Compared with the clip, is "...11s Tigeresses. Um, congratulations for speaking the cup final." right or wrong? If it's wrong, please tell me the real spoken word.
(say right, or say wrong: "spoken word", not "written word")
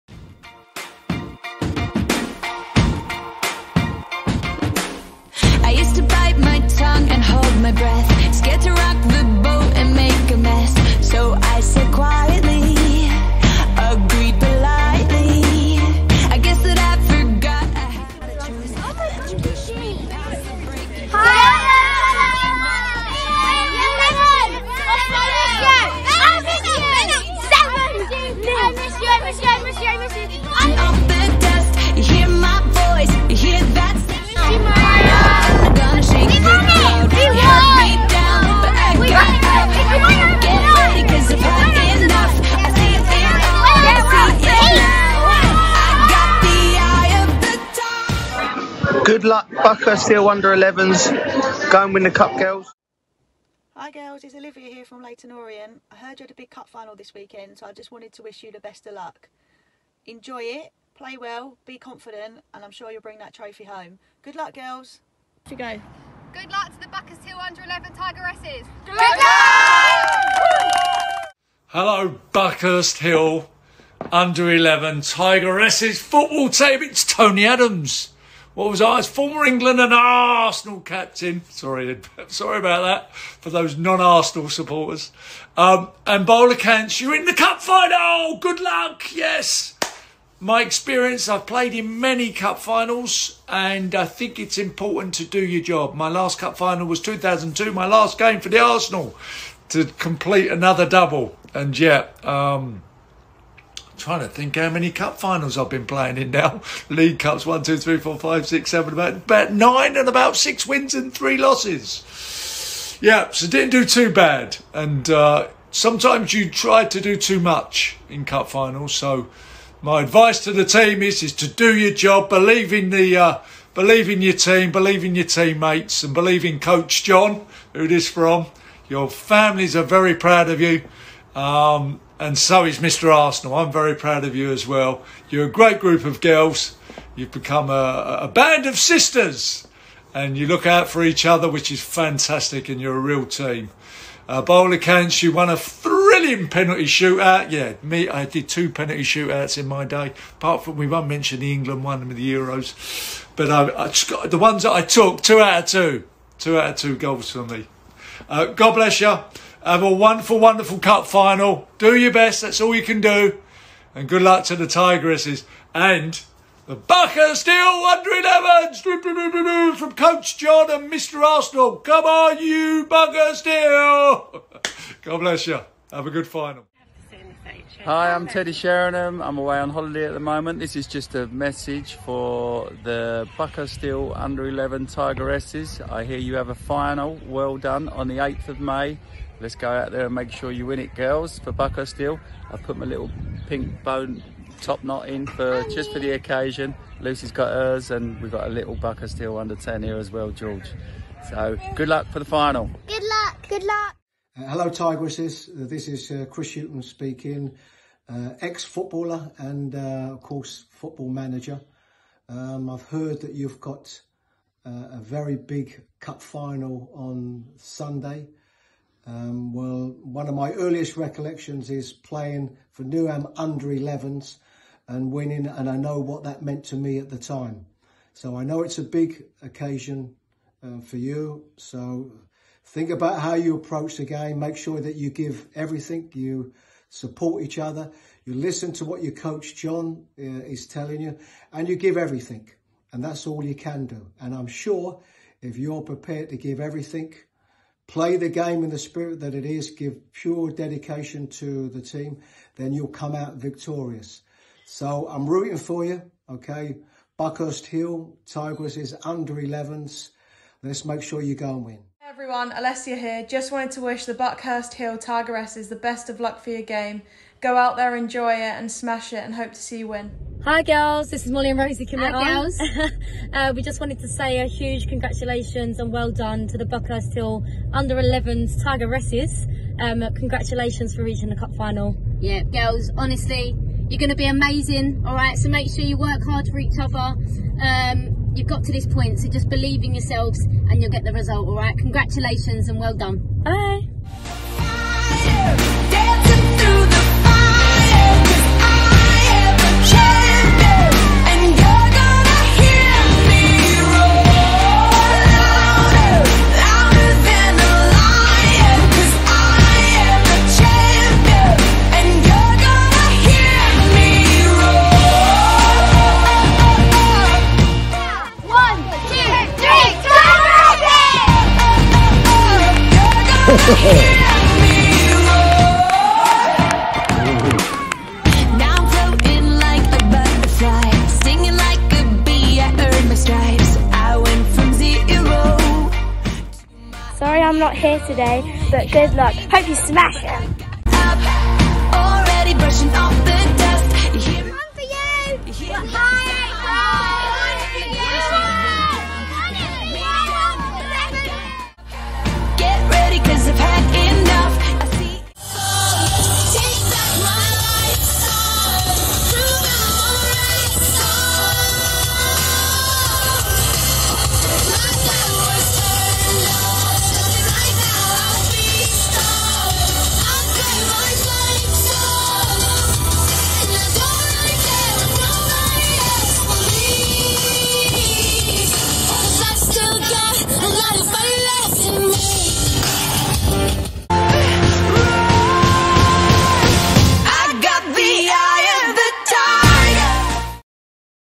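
wrong: "reaching", not "speaking".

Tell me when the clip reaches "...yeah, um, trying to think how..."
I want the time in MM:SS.
01:41.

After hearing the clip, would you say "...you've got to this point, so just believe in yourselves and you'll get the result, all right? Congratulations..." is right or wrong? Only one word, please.
right.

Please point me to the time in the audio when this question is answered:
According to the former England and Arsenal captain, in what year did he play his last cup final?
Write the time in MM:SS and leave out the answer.
01:36.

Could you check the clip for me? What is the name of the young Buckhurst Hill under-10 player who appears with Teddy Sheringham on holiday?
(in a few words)
George.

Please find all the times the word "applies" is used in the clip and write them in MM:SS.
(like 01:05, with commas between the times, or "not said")
not said.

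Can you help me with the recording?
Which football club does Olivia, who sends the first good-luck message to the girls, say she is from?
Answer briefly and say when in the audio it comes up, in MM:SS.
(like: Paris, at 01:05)
Leyton Orient, at 00:55.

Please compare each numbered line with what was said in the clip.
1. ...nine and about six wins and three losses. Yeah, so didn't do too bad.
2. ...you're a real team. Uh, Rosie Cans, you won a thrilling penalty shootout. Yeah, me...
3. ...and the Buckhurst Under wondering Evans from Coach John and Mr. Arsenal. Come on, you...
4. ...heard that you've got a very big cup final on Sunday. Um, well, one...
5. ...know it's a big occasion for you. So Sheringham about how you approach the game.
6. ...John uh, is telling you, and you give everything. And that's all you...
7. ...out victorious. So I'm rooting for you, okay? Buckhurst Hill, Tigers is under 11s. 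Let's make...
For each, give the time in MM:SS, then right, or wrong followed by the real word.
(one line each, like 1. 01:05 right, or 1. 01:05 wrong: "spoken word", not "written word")
1. 01:49 right
2. 02:22 wrong: "Bowler", not "Rosie"
3. 02:45 wrong: "Hill", not "Under"
4. 03:32 right
5. 03:48 wrong: "Think", not "Sheringham"
6. 03:59 right
7. 04:13 right.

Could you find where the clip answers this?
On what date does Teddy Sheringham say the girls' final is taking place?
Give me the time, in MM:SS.
03:08.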